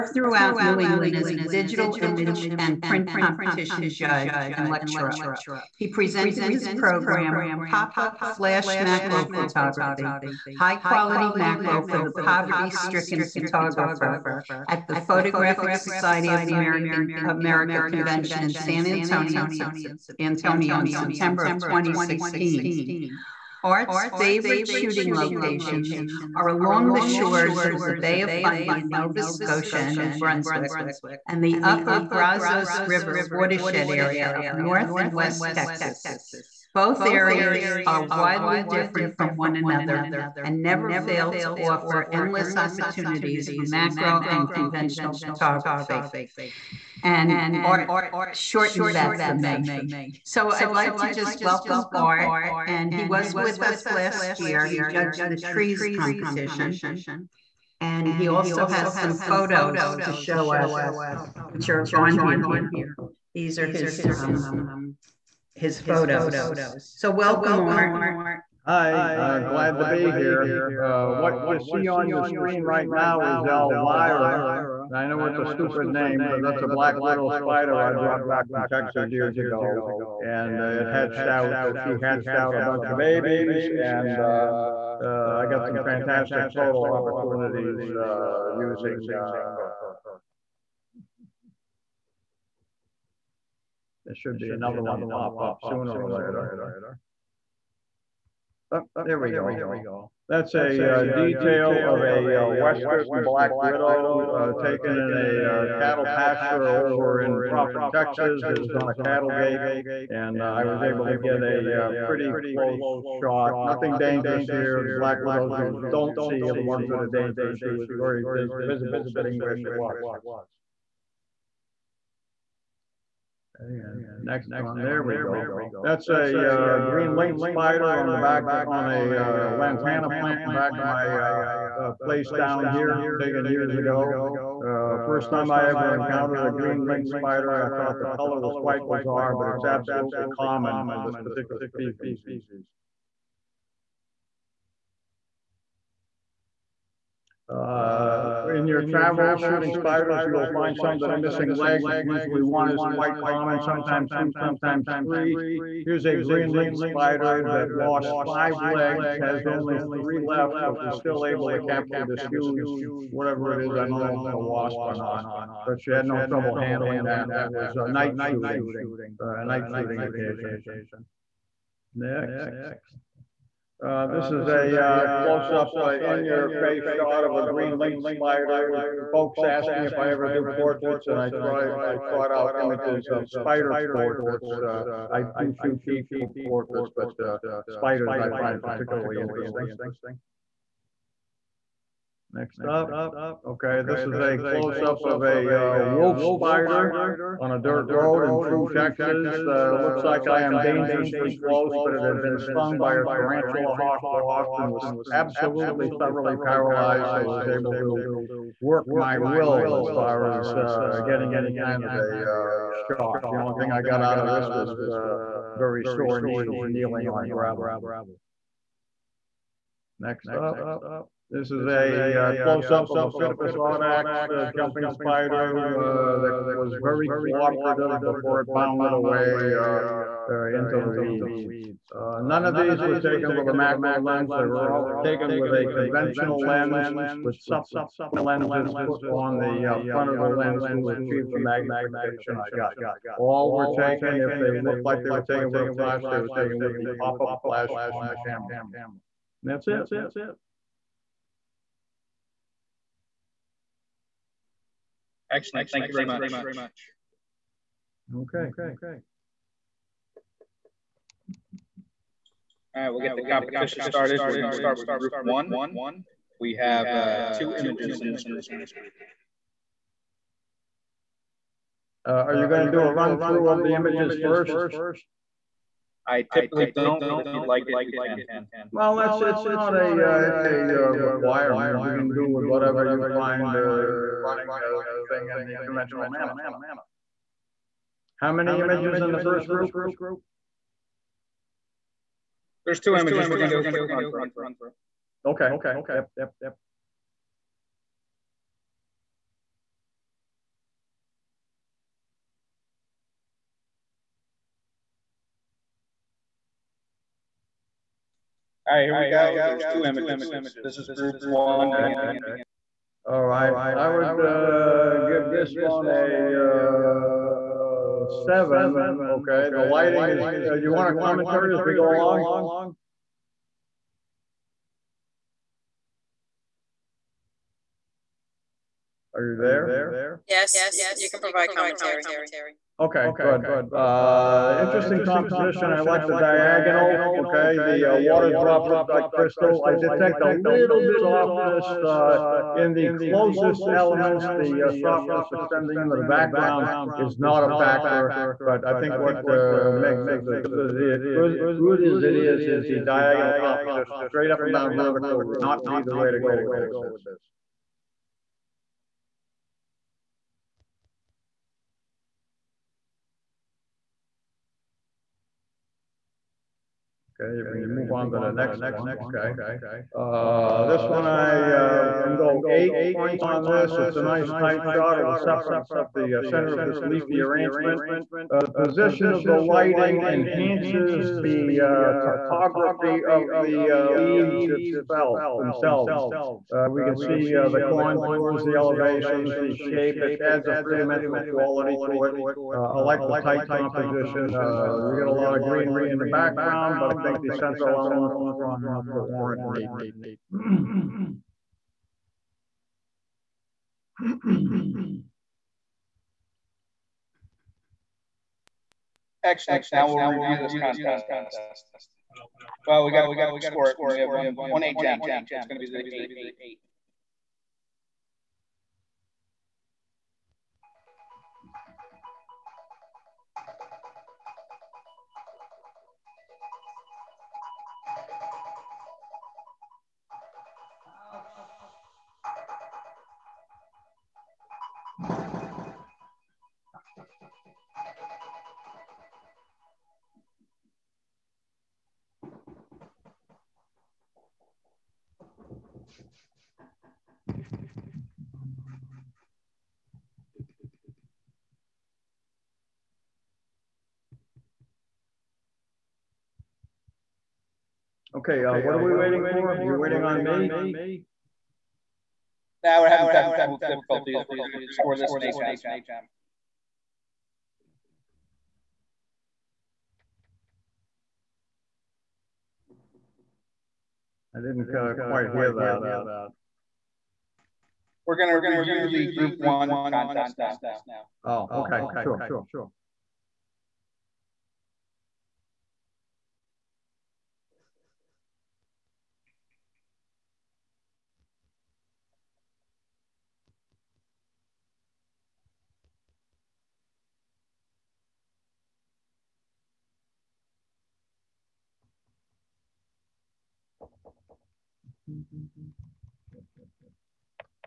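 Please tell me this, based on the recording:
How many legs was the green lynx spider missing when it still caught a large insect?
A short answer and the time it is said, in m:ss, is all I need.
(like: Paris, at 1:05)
5, at 2:38.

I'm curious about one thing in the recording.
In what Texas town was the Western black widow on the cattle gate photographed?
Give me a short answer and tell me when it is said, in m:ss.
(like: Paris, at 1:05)
Proffitt, at 1:47.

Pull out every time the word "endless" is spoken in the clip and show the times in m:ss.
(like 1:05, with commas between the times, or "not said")
0:42.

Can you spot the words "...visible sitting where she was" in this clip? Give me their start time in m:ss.
1:58.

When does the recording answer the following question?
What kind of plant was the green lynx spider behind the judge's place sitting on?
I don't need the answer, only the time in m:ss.
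2:09.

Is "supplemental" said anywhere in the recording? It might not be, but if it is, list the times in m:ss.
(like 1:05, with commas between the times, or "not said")
3:57.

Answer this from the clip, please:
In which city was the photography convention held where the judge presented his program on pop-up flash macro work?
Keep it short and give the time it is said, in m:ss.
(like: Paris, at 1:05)
San Antonio, at 0:18.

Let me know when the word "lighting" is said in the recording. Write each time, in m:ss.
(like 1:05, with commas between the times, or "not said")
5:19, 6:19.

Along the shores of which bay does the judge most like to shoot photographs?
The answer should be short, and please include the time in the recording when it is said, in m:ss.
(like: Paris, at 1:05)
Bay of Fundy, at 0:28.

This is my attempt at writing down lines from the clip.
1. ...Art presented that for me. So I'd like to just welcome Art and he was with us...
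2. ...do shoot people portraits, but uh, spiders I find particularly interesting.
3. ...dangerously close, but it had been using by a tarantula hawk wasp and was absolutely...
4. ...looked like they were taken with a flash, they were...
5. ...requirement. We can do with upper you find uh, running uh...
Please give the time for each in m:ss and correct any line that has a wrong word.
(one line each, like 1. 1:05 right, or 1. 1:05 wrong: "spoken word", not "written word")
1. 0:47 wrong: "shortened", not "presented"
2. 3:05 right
3. 3:20 wrong: "stung", not "using"
4. 4:04 right
5. 4:40 wrong: "whatever", not "upper".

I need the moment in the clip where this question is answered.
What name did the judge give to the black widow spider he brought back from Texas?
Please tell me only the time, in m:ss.
1:13.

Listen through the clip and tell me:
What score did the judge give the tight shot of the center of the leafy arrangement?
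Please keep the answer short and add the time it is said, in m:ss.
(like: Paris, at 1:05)
8, at 6:12.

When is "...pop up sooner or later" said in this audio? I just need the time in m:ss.
1:35.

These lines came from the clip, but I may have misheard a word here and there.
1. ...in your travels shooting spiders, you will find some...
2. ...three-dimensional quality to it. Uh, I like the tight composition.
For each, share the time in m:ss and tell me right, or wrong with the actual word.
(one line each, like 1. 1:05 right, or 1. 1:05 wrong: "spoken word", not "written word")
1. 2:28 right
2. 6:30 right.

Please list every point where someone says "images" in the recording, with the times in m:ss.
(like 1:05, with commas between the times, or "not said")
0:01, 3:02, 4:27, 4:33, 4:48, 4:52, 5:09.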